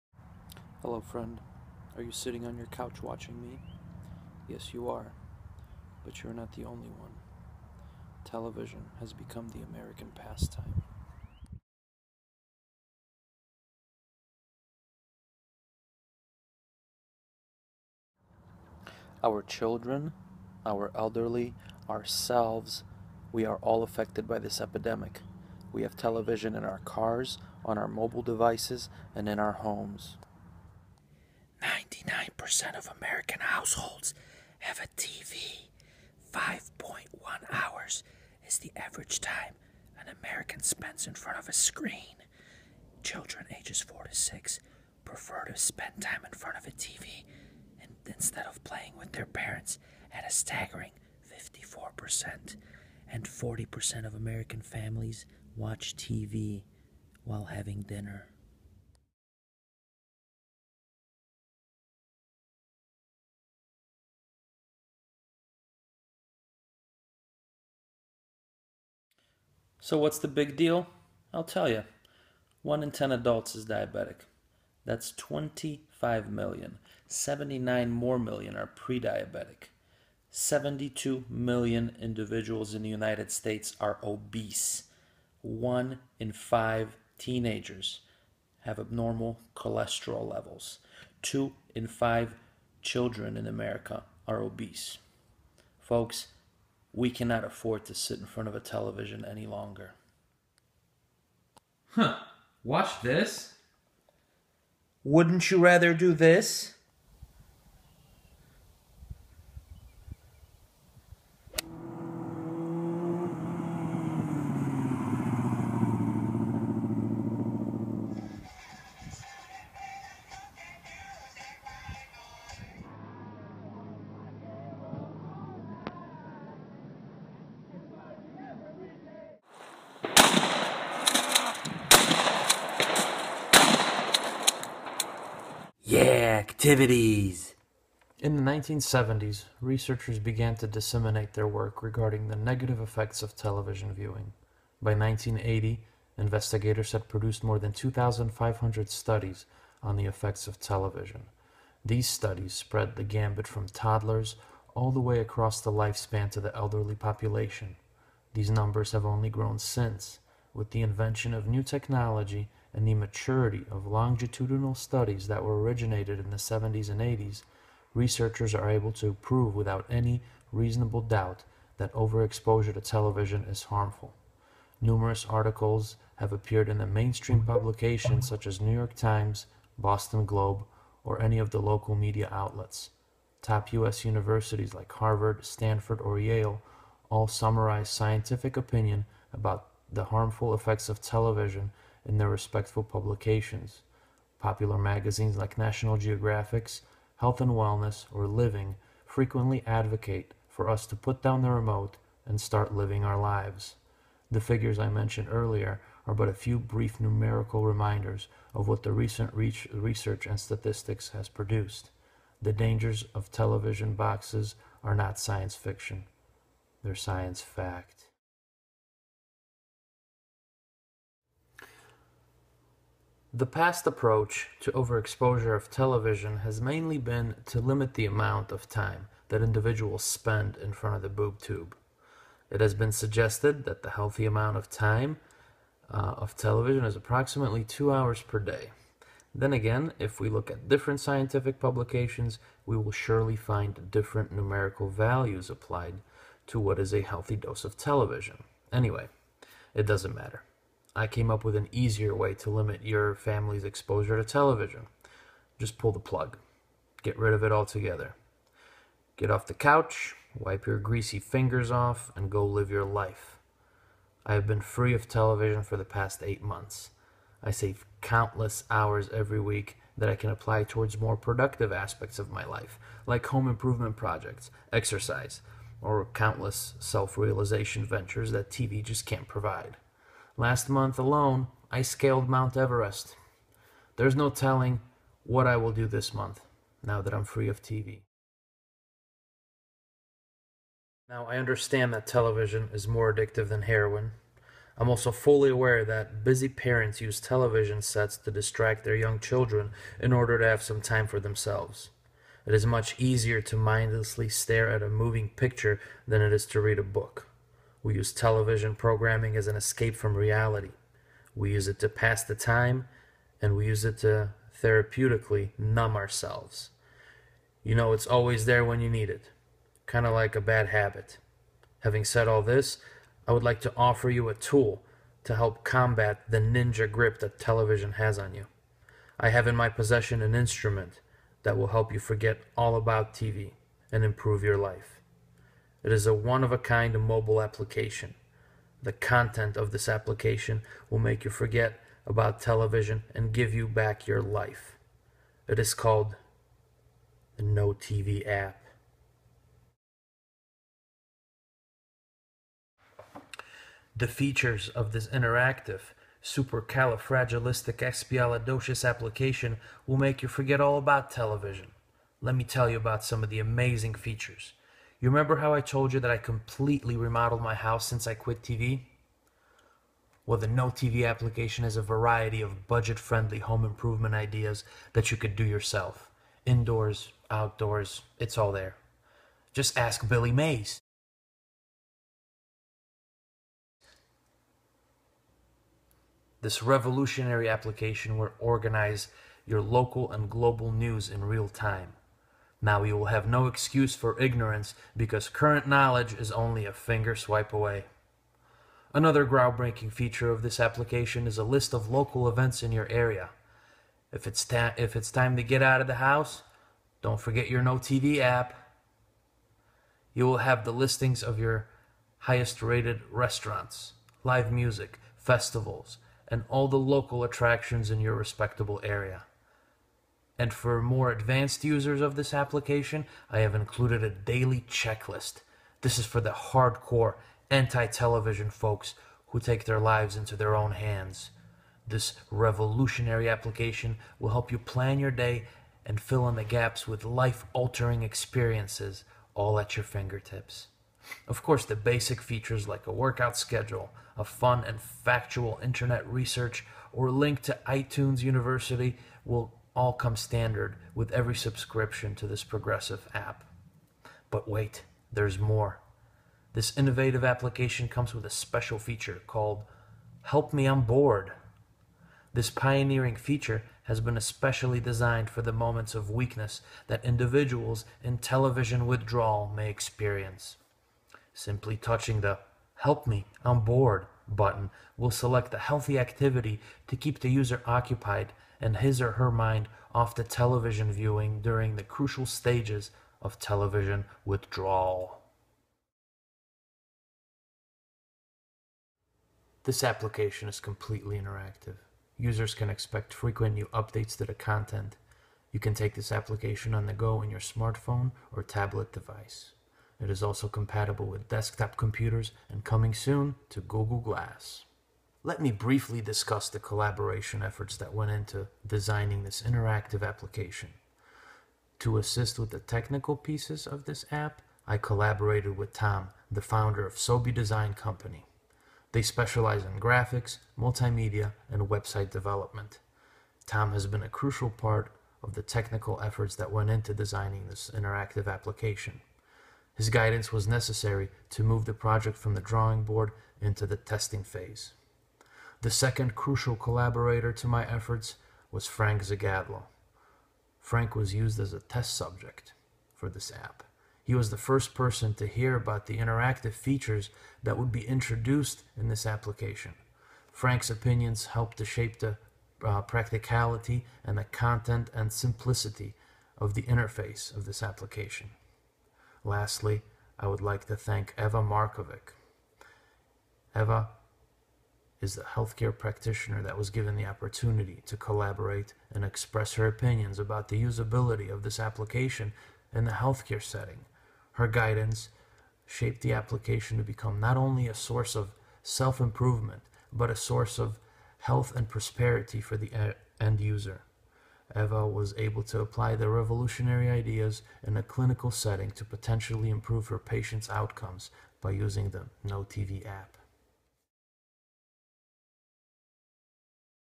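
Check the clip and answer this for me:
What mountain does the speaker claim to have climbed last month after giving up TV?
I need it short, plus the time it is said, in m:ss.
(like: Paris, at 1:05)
Mount Everest, at 4:42.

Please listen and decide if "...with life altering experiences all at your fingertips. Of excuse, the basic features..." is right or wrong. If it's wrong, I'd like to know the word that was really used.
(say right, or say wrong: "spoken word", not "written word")
wrong: "course", not "excuse".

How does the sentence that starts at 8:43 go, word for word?
Tom has been a crucial part of the technical efforts that went into designing this interactive application.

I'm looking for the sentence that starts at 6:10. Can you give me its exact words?
Well, the No TV application has a variety of budget friendly home improvement ideas that you could do yourself.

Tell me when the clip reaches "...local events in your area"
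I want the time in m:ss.
6:41.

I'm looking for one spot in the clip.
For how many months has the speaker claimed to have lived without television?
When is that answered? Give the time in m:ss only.
4:26.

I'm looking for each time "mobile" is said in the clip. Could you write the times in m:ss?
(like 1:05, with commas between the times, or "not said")
0:27, 5:37.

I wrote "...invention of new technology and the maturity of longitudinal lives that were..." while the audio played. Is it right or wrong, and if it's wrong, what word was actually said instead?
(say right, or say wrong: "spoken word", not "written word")
wrong: "studies", not "lives".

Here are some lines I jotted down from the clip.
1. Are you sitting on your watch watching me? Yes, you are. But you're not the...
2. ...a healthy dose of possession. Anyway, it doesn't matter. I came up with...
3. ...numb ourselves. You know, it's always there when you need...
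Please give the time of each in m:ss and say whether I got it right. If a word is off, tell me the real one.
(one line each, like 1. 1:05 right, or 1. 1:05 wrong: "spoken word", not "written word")
1. 0:01 wrong: "couch", not "watch"
2. 4:06 wrong: "television", not "possession"
3. 5:15 right.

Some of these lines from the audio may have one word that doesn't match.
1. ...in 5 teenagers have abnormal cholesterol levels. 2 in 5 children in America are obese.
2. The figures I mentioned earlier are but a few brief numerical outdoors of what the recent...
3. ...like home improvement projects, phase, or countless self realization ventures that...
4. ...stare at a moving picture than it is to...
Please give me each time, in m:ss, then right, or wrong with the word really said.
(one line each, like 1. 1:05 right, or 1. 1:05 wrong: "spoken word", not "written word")
1. 1:26 right
2. 3:24 wrong: "reminders", not "outdoors"
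3. 4:33 wrong: "exercise", not "phase"
4. 5:04 right.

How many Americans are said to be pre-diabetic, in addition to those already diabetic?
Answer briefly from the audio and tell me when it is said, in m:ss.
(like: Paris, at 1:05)
79 million, at 1:17.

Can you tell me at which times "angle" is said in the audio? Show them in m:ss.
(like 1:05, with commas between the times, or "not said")
not said.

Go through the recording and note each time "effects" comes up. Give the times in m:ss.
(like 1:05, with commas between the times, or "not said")
2:22, 2:30, 3:10.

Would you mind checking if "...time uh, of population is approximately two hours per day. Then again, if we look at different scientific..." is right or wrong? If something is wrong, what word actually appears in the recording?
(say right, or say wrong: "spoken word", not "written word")
wrong: "television", not "population".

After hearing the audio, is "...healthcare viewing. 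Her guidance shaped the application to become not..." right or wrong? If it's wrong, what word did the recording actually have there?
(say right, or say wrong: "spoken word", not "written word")
wrong: "setting", not "viewing".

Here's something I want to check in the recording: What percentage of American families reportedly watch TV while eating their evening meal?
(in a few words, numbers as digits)
40%.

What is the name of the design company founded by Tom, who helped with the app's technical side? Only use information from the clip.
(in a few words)
Sobe Design Company.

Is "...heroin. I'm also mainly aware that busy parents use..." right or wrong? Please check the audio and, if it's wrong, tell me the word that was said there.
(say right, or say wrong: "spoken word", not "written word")
wrong: "fully", not "mainly".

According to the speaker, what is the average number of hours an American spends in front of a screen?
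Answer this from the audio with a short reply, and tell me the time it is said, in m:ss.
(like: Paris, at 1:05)
5.1 hours, at 0:36.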